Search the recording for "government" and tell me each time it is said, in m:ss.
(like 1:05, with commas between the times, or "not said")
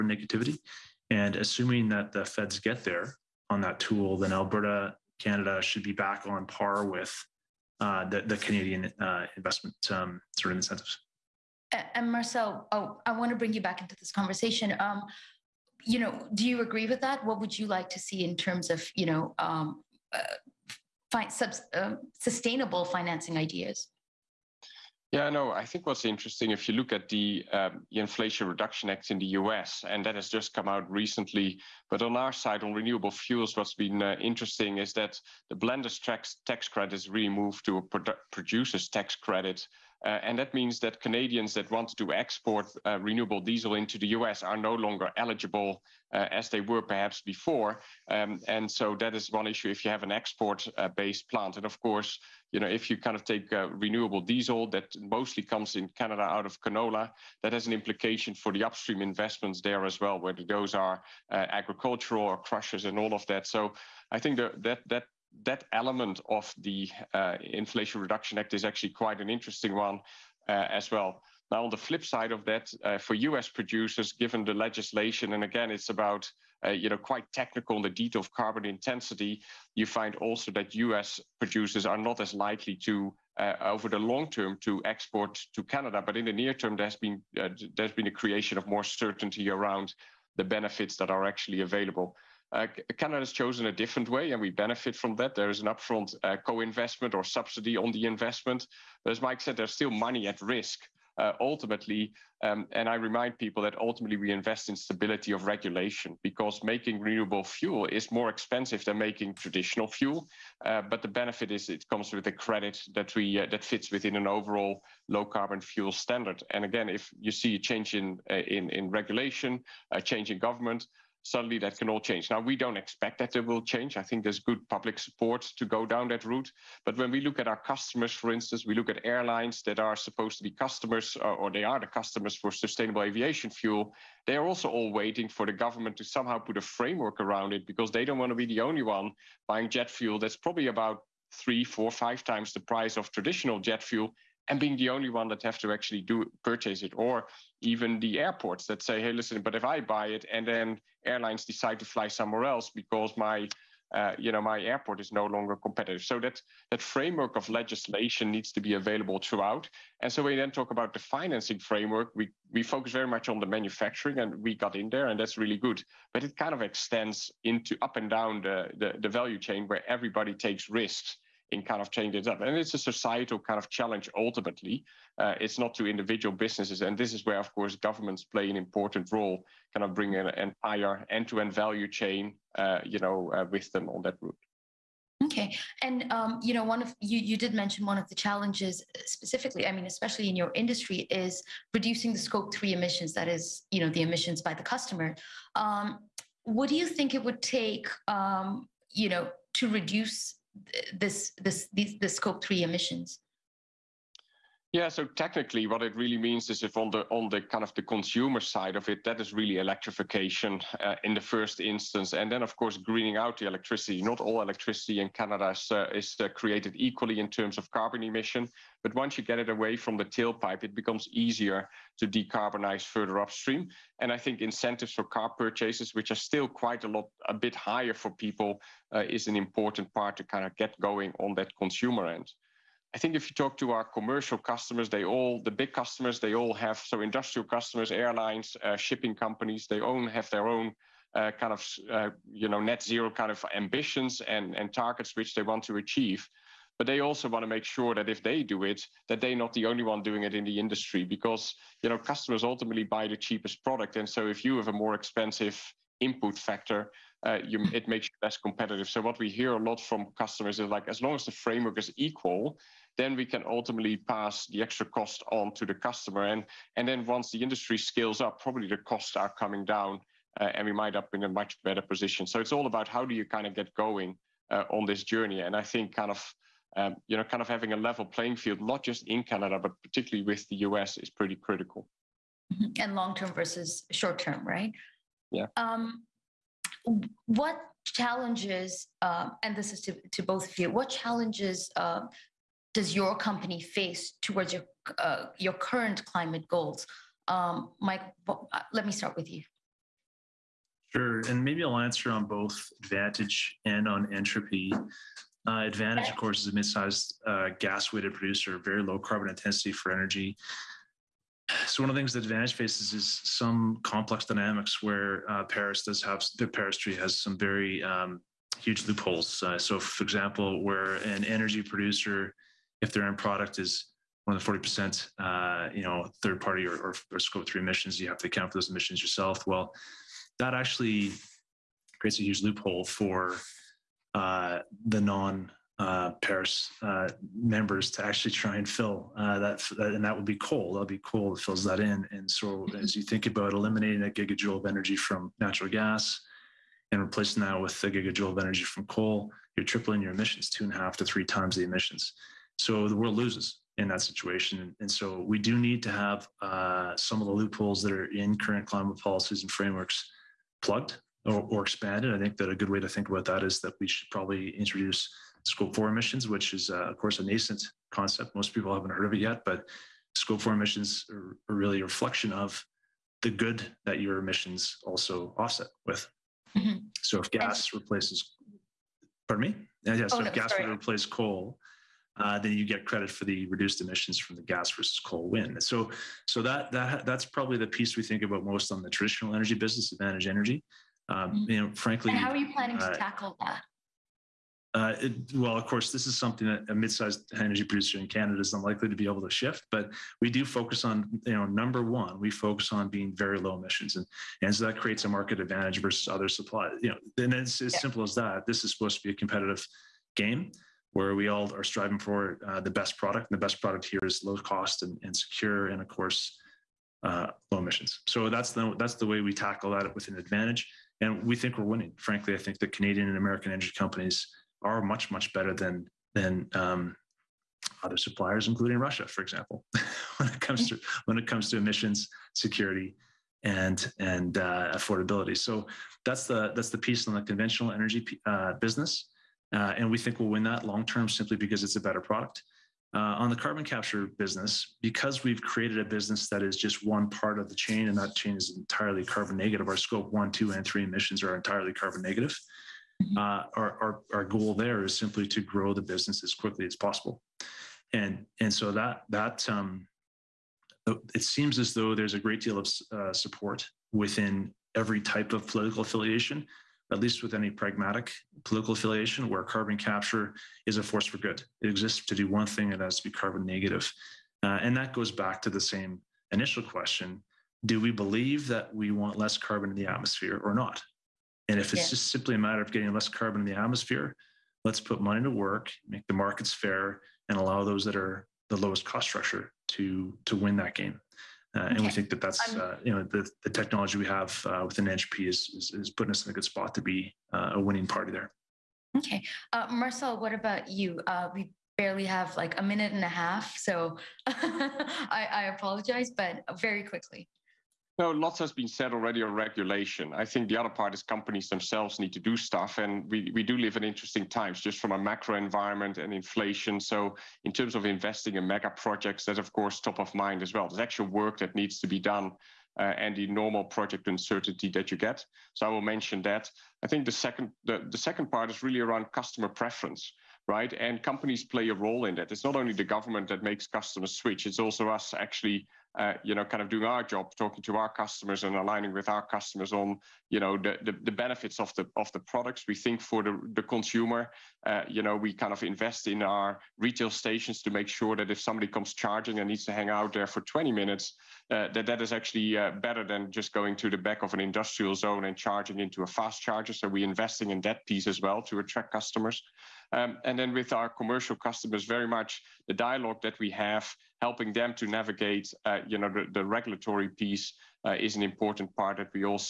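2:00, 2:15, 2:57, 8:52.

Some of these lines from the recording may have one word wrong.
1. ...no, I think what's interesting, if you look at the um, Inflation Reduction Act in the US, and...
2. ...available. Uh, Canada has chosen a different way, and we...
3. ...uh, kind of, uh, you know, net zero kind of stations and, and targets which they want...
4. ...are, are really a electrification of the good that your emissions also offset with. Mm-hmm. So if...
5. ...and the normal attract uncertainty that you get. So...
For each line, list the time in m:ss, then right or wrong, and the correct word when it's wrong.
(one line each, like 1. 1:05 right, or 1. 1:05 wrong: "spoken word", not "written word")
1. 0:25 right
2. 1:31 right
3. 4:01 wrong: "ambitions", not "stations"
4. 6:11 wrong: "reflection", not "electrification"
5. 8:42 wrong: "project", not "attract".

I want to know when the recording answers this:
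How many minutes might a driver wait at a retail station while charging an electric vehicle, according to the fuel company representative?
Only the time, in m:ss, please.
9:10.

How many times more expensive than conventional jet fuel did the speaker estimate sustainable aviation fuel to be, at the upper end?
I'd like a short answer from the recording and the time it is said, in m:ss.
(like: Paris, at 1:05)
5, at 2:21.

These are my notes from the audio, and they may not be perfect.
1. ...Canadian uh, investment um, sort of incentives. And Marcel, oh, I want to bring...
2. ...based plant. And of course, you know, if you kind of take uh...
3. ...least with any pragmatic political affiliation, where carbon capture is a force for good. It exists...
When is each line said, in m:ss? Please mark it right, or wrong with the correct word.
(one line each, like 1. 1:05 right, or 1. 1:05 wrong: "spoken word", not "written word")
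1. 0:08 right
2. 0:50 right
3. 7:46 right.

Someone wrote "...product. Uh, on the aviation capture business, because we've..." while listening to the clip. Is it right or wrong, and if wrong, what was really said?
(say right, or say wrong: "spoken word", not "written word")
wrong: "carbon", not "aviation".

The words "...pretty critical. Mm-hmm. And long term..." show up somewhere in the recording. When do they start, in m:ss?
4:41.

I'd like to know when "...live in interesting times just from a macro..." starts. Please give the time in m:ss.
8:33.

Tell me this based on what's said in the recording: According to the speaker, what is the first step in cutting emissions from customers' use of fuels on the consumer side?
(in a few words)
electrification.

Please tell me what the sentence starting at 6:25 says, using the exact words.
So, so that that that's probably the piece we think about most on the traditional energy business, advantage energy.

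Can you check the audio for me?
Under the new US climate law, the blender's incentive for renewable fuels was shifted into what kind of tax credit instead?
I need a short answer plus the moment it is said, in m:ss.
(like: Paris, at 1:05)
producer's tax credit, at 0:38.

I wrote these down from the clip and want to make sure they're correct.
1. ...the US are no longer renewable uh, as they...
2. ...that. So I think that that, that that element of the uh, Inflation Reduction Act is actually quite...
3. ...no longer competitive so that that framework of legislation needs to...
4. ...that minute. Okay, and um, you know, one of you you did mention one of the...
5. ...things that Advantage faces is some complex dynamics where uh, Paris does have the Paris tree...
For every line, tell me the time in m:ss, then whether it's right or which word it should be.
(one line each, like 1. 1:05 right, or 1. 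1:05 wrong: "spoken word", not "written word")
1. 0:43 wrong: "eligible", not "renewable"
2. 1:03 right
3. 2:35 right
4. 3:04 wrong: "route", not "minute"
5. 5:11 right.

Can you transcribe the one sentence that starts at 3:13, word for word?
That is, you know, the emissions by the customer.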